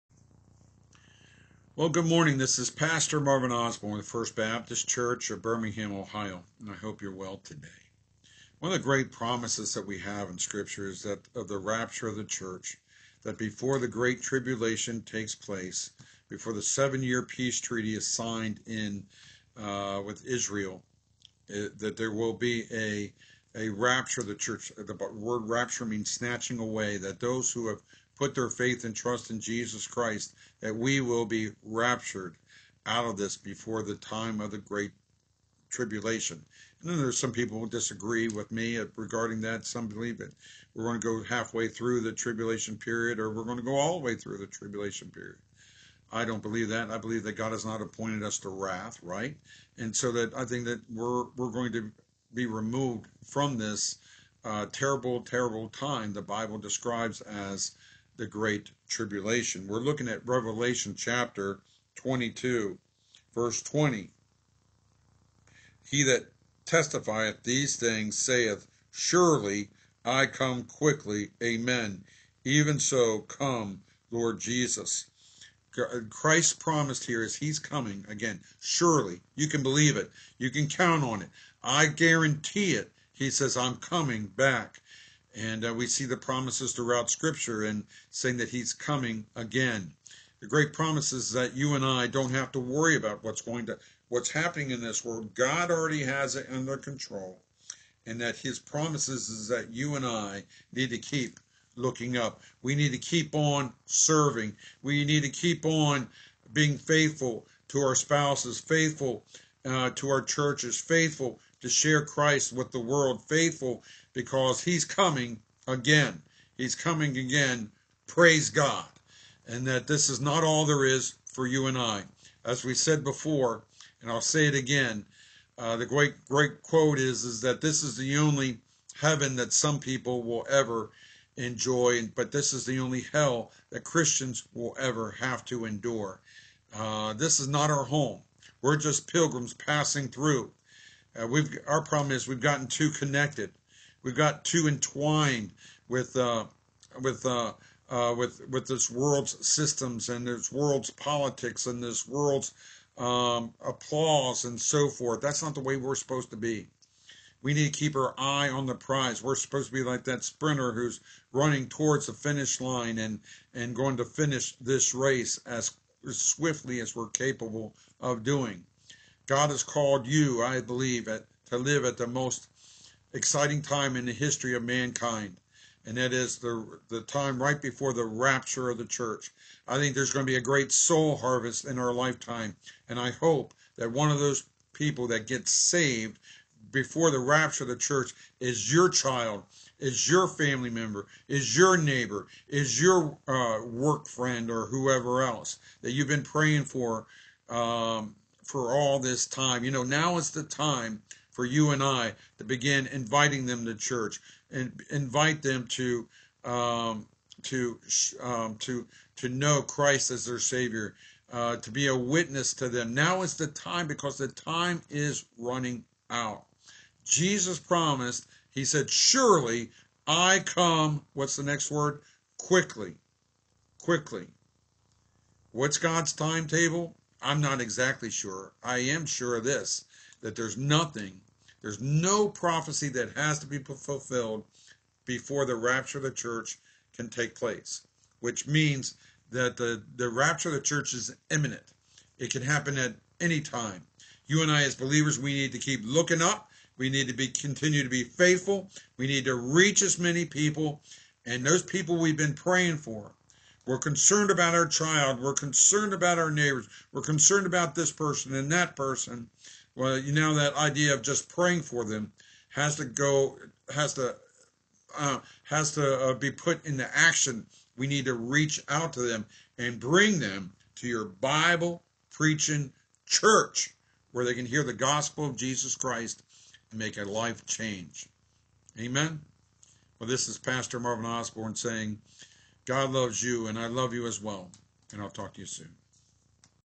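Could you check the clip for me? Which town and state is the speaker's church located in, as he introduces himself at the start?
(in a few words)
Birmingham, Ohio.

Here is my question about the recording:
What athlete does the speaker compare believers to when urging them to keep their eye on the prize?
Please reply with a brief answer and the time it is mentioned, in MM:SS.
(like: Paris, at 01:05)
sprinter, at 02:40.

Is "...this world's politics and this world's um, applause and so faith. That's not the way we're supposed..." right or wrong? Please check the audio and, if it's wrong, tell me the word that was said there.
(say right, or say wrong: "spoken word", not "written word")
wrong: "forth", not "faith".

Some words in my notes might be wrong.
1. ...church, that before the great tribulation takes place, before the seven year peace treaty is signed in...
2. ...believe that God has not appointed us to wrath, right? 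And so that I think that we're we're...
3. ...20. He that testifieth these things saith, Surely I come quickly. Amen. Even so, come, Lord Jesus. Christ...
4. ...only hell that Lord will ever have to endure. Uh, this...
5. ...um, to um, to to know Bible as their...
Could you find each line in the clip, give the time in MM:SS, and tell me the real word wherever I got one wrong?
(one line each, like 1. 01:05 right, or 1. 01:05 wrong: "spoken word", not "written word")
1. 00:12 right
2. 00:46 right
3. 01:03 right
4. 02:12 wrong: "Christians", not "Lord"
5. 03:26 wrong: "Christ", not "Bible".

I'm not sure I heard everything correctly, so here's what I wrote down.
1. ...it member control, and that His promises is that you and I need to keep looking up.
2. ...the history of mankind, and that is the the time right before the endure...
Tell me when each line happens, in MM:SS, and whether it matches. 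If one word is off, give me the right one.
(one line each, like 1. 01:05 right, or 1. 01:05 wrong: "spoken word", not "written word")
1. 01:36 wrong: "under", not "member"
2. 02:54 wrong: "rapture", not "endure".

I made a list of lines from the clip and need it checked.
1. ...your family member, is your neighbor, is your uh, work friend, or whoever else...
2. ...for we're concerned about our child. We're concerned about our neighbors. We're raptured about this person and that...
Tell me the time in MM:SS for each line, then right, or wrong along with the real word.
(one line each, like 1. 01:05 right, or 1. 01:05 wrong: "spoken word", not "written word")
1. 03:10 right
2. 04:12 wrong: "concerned", not "raptured".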